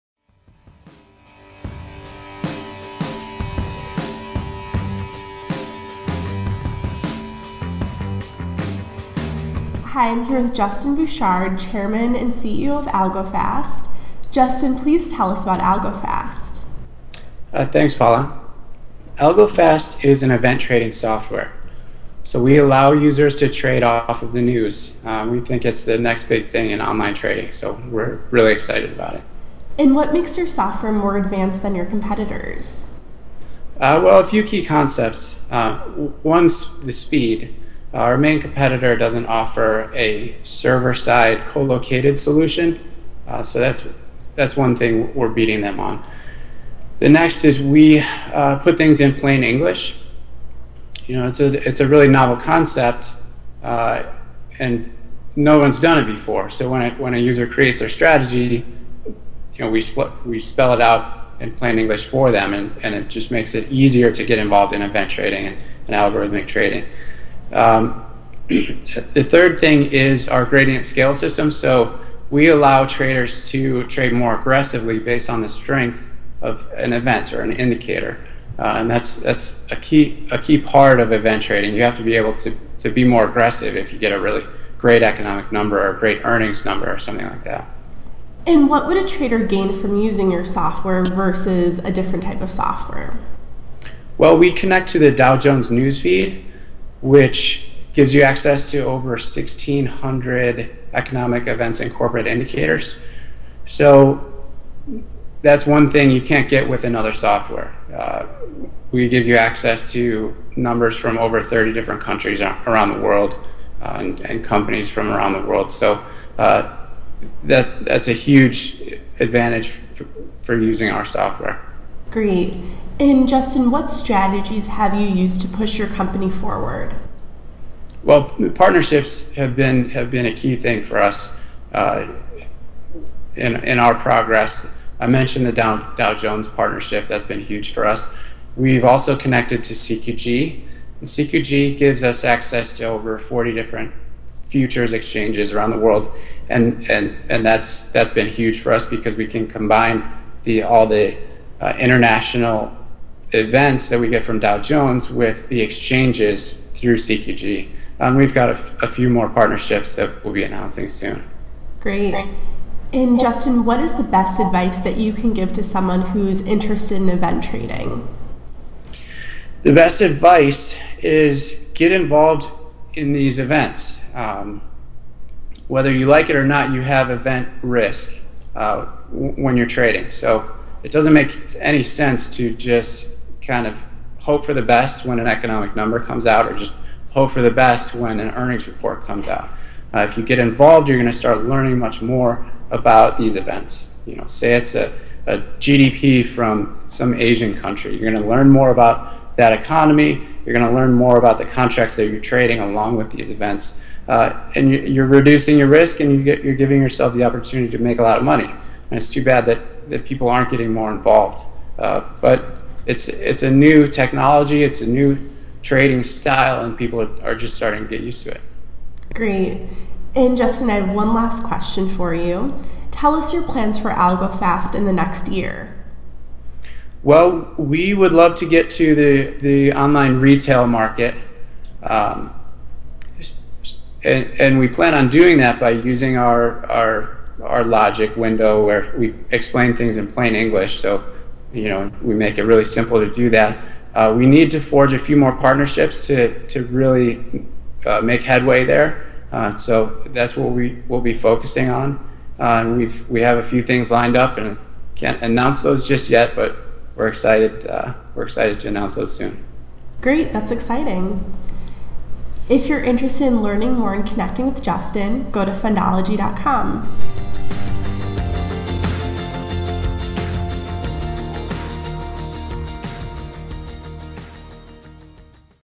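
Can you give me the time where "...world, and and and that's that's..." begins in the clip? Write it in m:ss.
2:25.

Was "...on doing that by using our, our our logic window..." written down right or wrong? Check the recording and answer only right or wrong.
right.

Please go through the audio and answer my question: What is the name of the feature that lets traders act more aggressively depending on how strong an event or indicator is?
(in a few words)
gradient scale system.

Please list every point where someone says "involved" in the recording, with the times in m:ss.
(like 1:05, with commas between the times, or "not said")
1:04, 2:51, 3:10, 3:30.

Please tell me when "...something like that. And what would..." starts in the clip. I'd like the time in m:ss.
1:26.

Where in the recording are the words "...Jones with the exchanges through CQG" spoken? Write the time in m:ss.
2:34.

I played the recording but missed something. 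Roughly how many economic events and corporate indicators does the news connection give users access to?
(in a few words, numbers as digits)
1,600.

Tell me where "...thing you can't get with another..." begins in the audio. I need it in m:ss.
1:45.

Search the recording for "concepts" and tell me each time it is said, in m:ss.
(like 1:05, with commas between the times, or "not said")
0:34, 0:52.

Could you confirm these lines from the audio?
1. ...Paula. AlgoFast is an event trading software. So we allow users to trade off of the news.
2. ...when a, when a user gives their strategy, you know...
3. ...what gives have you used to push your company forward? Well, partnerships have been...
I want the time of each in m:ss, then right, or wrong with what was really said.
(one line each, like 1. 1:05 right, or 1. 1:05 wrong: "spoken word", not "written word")
1. 0:17 right
2. 0:56 wrong: "creates", not "gives"
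3. 2:03 wrong: "strategies", not "gives".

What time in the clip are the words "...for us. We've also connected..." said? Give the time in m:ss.
2:17.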